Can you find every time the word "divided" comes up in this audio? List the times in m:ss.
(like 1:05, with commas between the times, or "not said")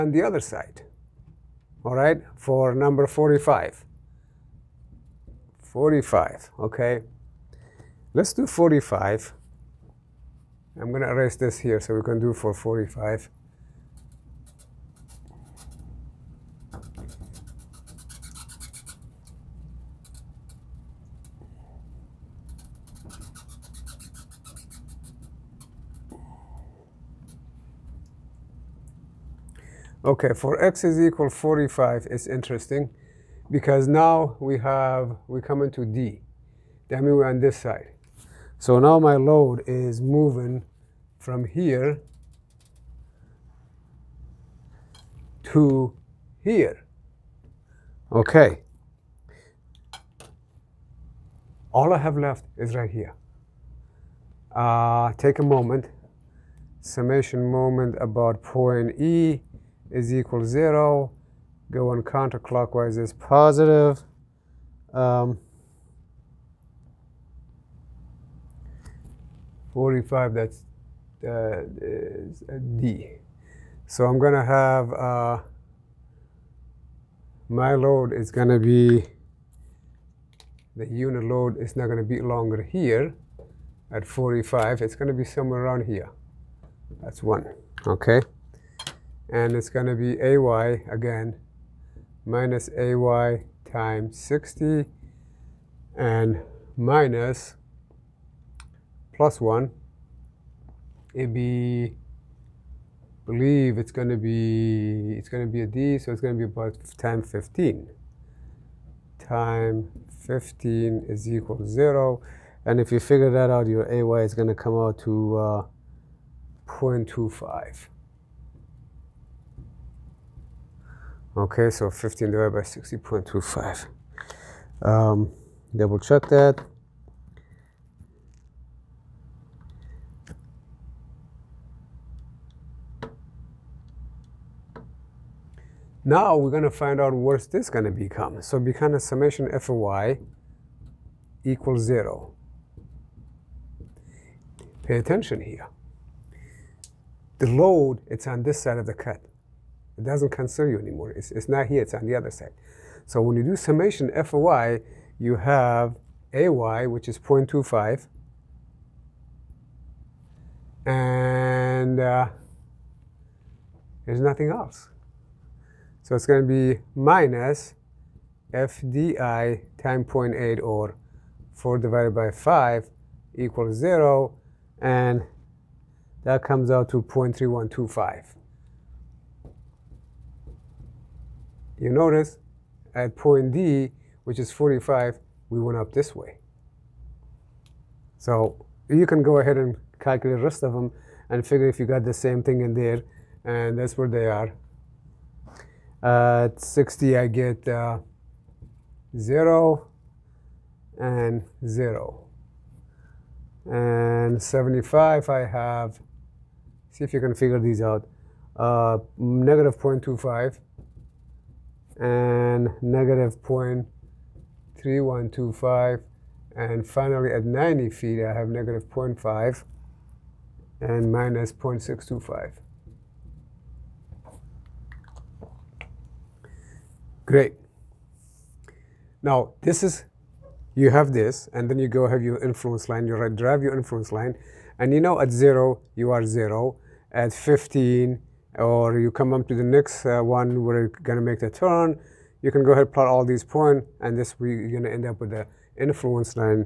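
2:02, 2:51.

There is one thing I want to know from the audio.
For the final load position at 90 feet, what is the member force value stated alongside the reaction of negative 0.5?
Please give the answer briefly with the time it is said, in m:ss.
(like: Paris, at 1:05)
-0.625, at 3:41.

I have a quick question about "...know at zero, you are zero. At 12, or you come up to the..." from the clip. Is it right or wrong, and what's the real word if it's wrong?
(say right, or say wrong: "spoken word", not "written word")
wrong: "15", not "12".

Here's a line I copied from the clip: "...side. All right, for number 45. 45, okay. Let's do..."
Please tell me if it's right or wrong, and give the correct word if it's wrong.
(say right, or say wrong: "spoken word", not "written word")
right.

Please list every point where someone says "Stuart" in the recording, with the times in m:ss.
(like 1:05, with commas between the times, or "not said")
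not said.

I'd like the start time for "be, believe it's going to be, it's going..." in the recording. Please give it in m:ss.
1:41.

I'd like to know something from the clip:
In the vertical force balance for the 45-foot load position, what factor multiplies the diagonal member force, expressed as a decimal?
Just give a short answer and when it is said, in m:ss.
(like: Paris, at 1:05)
0.8, at 2:50.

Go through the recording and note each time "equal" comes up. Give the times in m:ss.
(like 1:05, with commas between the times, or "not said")
0:30, 1:00, 1:51, 2:21, 2:53.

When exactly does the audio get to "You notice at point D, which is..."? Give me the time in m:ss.
3:01.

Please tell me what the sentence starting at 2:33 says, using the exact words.
So when you do summation f of y, you have ay, which is 0.25, and uh, there's nothing else.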